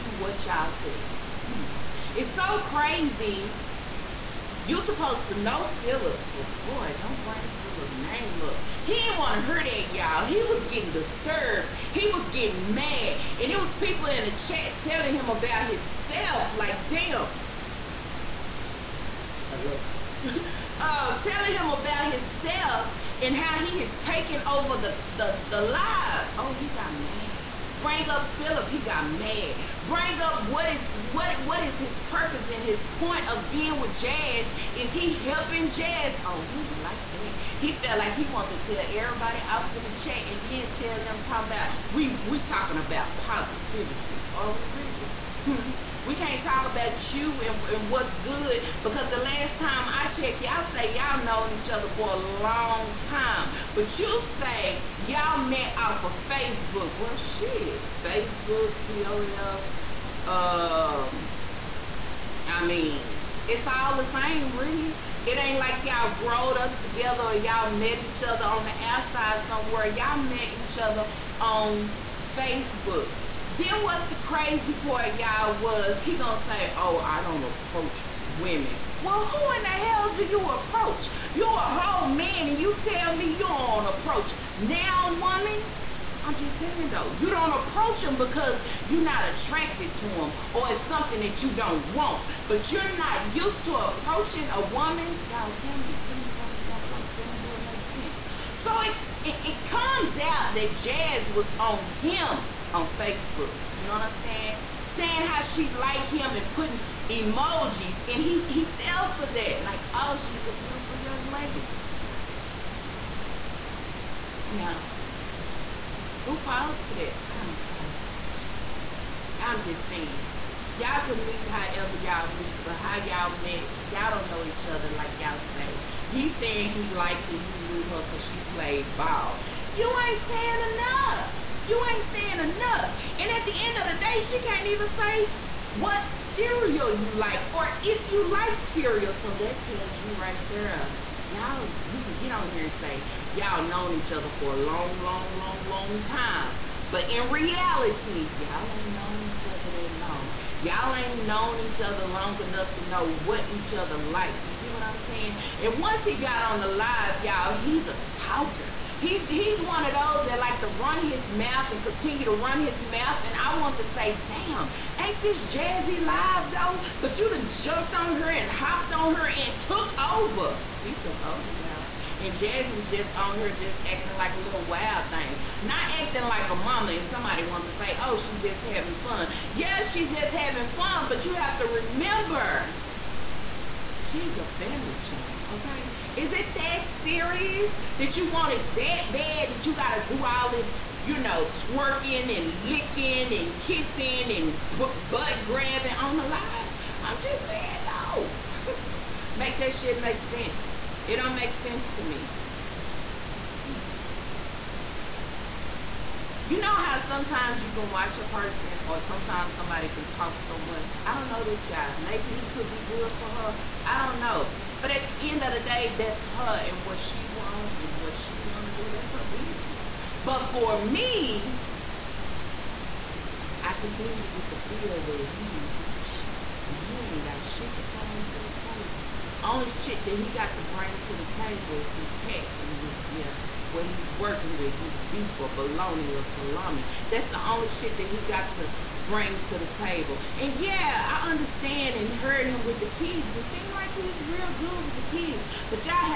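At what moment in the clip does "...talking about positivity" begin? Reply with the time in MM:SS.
00:42.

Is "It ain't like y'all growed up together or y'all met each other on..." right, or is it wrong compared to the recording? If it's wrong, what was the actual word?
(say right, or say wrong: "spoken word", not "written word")
right.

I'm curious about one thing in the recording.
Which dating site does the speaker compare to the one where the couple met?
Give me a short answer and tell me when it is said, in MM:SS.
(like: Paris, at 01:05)
POF, at 00:58.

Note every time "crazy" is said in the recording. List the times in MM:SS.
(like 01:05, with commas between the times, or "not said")
00:02, 01:14.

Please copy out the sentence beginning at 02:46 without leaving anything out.
But you done jumped on her and hopped on her and took over he took over, y'all.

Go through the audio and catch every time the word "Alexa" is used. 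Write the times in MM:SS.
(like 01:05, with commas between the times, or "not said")
00:19.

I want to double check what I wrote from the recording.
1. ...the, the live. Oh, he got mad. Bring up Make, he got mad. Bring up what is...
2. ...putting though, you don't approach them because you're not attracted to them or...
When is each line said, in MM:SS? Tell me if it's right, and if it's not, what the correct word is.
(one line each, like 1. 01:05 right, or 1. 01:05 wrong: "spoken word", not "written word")
1. 00:25 wrong: "Philip", not "Make"
2. 01:26 wrong: "saying", not "putting".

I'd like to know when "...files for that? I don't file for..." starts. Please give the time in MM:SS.
01:56.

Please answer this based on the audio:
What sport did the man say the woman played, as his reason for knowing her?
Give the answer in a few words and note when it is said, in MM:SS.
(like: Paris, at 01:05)
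ball, at 02:08.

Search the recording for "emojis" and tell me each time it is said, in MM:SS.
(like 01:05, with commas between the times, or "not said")
01:47.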